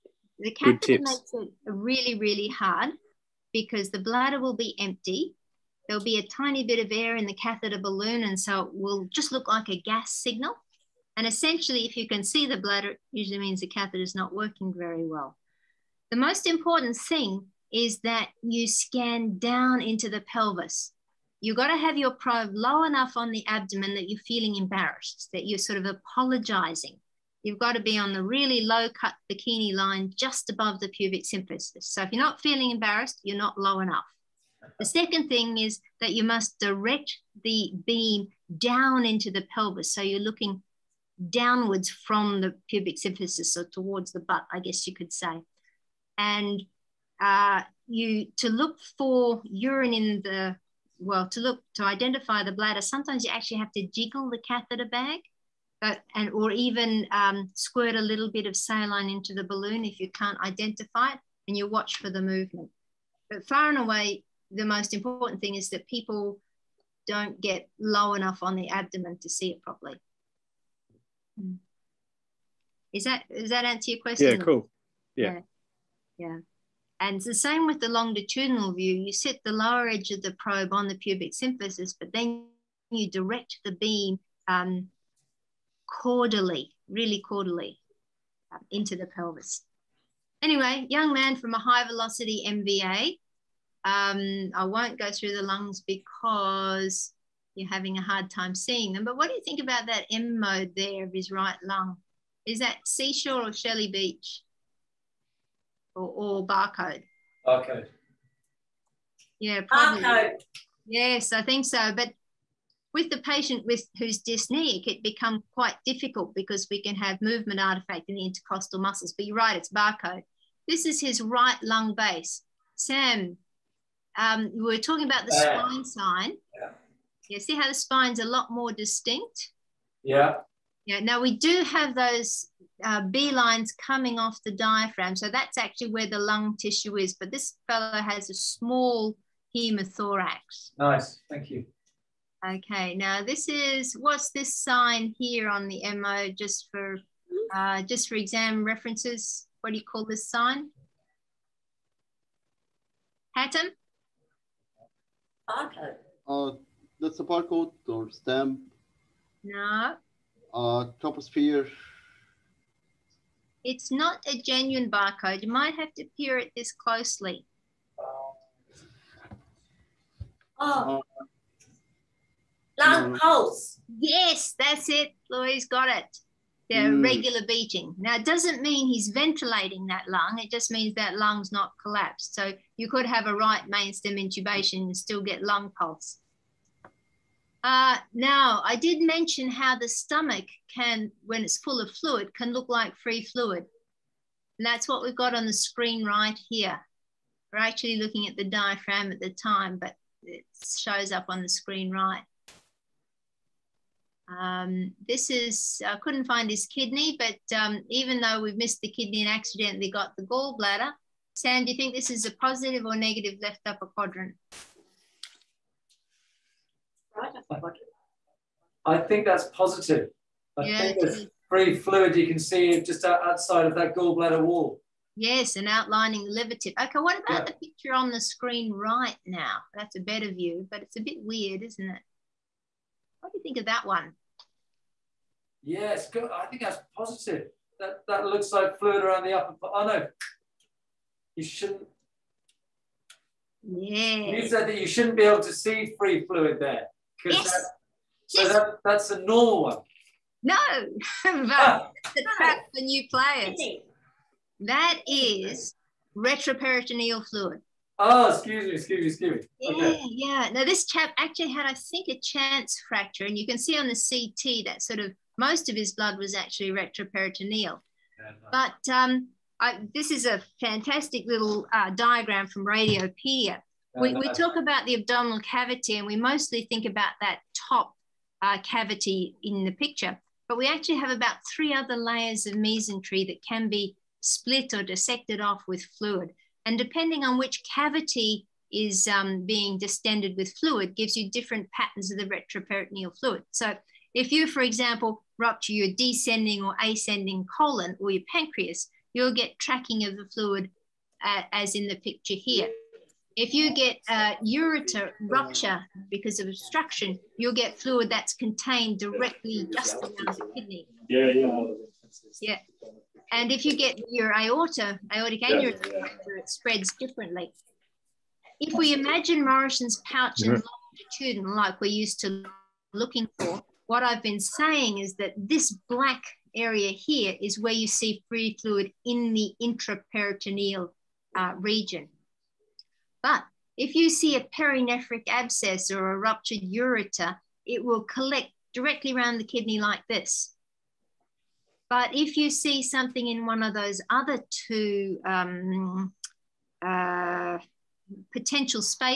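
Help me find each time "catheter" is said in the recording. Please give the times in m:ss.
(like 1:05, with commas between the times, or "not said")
0:00, 0:07, 0:13, 0:54.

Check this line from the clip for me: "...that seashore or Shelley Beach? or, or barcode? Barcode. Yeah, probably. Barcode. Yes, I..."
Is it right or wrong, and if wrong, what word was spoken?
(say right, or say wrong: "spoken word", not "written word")
right.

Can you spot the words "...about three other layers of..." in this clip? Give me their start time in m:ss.
4:41.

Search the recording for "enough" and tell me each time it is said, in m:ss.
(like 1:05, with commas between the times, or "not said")
0:22, 0:33, 1:08.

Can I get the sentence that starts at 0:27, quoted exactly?
You've got to be on the really low cut bikini line just above the pubic symphysis.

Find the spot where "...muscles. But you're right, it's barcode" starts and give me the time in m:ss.
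1:58.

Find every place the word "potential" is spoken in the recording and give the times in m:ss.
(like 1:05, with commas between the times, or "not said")
5:48.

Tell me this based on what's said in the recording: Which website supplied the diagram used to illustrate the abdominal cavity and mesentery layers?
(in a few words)
Radiopaedia.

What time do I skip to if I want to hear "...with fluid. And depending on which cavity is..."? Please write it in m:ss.
4:45.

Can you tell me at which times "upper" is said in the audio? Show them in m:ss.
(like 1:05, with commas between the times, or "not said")
3:33, 3:59.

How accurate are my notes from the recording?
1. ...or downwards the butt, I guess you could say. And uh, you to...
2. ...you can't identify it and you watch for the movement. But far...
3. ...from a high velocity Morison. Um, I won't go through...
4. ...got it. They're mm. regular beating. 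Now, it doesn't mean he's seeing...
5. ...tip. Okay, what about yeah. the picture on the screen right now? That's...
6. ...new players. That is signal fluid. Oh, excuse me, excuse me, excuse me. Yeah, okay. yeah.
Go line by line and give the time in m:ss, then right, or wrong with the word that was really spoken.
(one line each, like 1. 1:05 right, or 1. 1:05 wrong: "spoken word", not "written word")
1. 0:43 wrong: "towards", not "downwards"
2. 0:59 right
3. 1:31 wrong: "MVA", not "Morison"
4. 2:55 wrong: "ventilating", not "seeing"
5. 3:46 right
6. 4:12 wrong: "retroperitoneal", not "signal".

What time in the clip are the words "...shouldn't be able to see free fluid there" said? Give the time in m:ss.
4:04.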